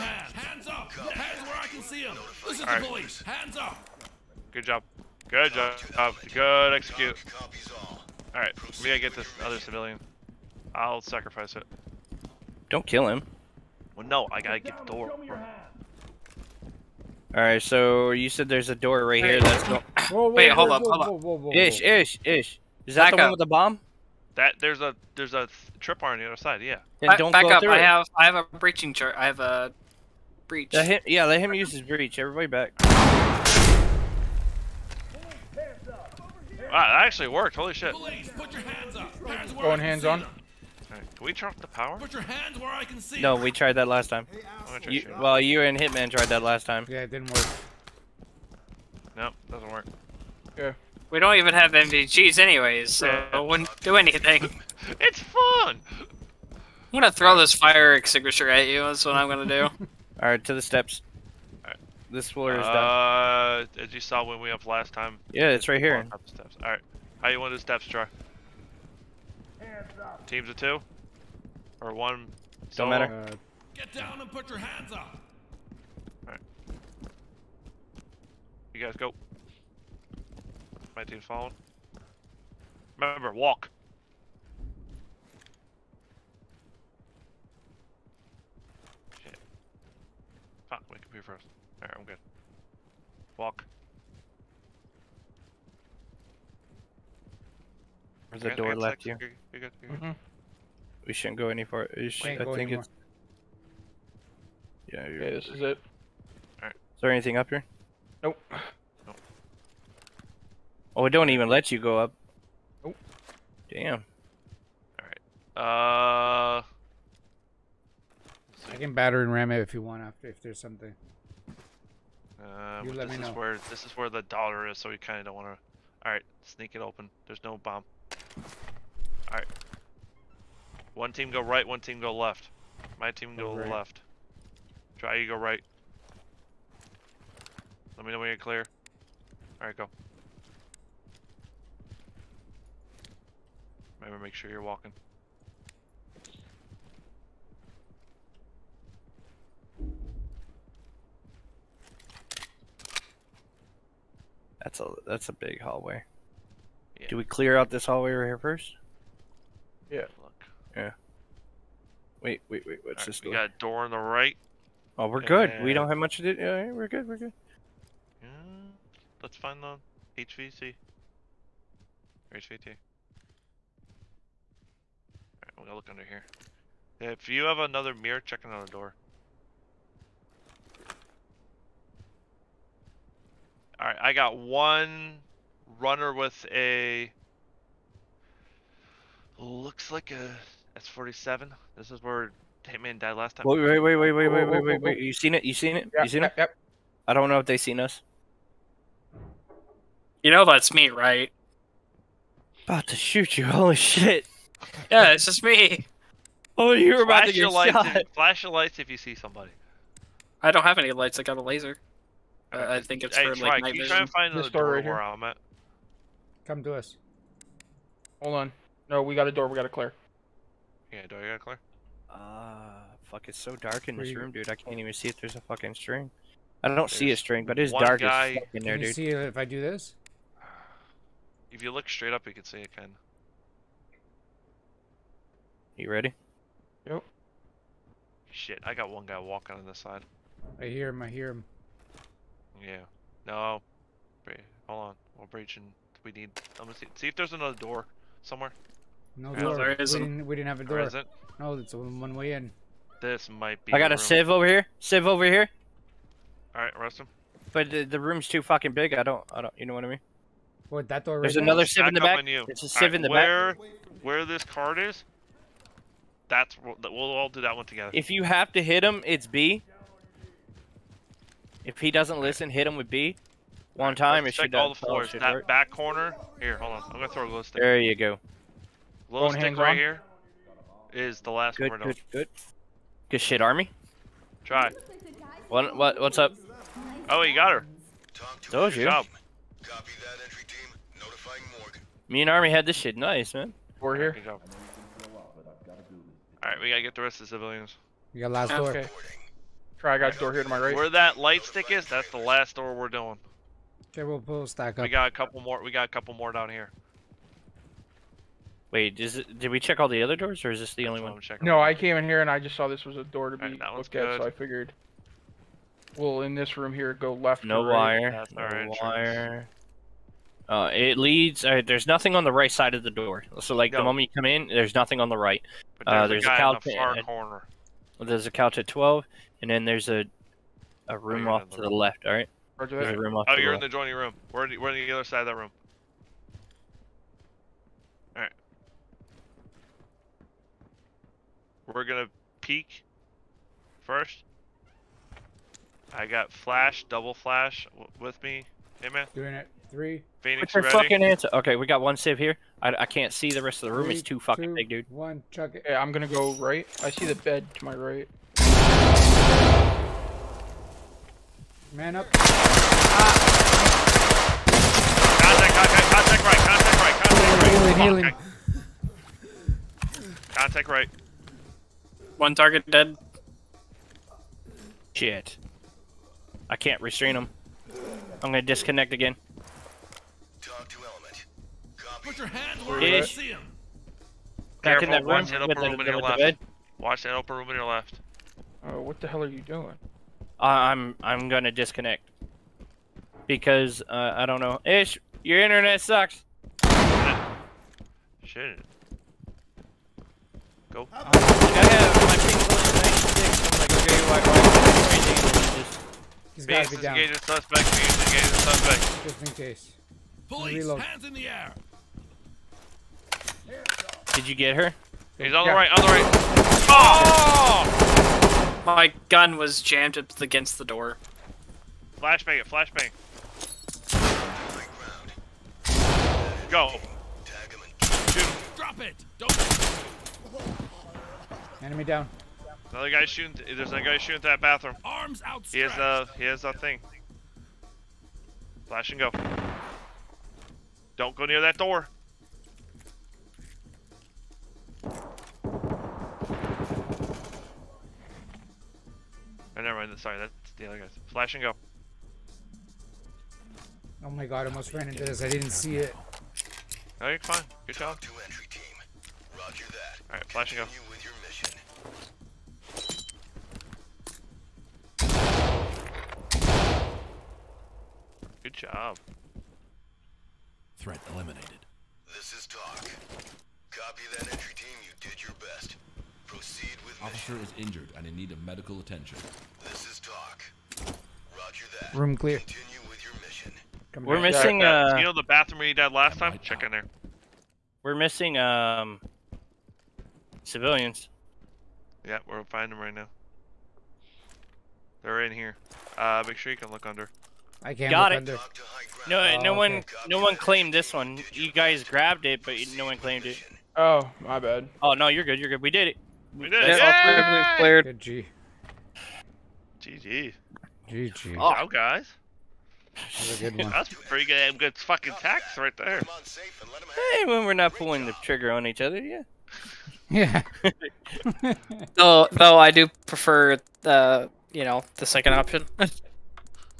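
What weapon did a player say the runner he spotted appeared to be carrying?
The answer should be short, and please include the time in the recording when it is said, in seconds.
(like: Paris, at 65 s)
S47, at 190 s.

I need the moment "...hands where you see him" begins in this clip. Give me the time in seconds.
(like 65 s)
382 s.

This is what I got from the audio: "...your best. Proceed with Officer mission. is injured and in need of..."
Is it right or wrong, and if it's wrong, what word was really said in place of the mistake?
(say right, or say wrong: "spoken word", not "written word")
right.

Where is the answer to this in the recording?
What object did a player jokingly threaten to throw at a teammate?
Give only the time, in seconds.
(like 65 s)
57 s.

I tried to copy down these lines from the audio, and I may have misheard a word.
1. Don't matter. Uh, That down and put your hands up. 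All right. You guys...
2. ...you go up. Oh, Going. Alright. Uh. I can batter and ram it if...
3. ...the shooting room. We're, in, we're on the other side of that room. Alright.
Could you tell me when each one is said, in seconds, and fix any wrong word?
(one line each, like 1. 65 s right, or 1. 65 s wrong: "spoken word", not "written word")
1. 72 s wrong: "Get", not "That"
2. 111 s wrong: "Damn", not "Going"
3. 333 s wrong: "joining", not "shooting".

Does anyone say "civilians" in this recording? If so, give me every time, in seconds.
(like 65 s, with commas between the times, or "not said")
9 s, 297 s, 490 s.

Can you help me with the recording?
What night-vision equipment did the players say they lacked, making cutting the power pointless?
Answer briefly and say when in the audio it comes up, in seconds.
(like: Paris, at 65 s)
NVGs, at 51 s.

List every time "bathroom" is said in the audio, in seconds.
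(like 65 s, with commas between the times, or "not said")
434 s, 485 s.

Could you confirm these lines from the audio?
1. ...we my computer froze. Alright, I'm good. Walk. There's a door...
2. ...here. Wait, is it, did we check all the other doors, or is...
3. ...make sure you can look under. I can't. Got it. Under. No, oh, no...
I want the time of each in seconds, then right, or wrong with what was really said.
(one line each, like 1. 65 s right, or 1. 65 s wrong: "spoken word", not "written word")
1. 90 s right
2. 306 s right
3. 496 s right.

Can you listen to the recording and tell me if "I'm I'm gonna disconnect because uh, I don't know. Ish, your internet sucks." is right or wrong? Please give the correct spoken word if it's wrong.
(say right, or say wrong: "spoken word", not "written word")
right.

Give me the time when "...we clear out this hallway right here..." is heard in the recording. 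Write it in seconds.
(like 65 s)
157 s.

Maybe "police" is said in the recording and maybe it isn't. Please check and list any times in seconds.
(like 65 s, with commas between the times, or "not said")
2 s, 37 s, 410 s.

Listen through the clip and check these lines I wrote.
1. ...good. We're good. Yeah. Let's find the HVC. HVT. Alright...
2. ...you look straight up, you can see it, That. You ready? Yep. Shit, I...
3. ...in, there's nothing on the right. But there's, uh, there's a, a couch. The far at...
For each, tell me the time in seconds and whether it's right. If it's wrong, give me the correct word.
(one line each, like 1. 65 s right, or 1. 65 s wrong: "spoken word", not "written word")
1. 166 s right
2. 231 s wrong: "Ken", not "That"
3. 324 s right.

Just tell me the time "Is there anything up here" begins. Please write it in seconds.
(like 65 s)
106 s.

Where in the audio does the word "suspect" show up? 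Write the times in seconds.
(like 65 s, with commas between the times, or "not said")
402 s, 408 s.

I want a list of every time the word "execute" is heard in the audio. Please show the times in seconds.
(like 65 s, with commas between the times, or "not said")
6 s.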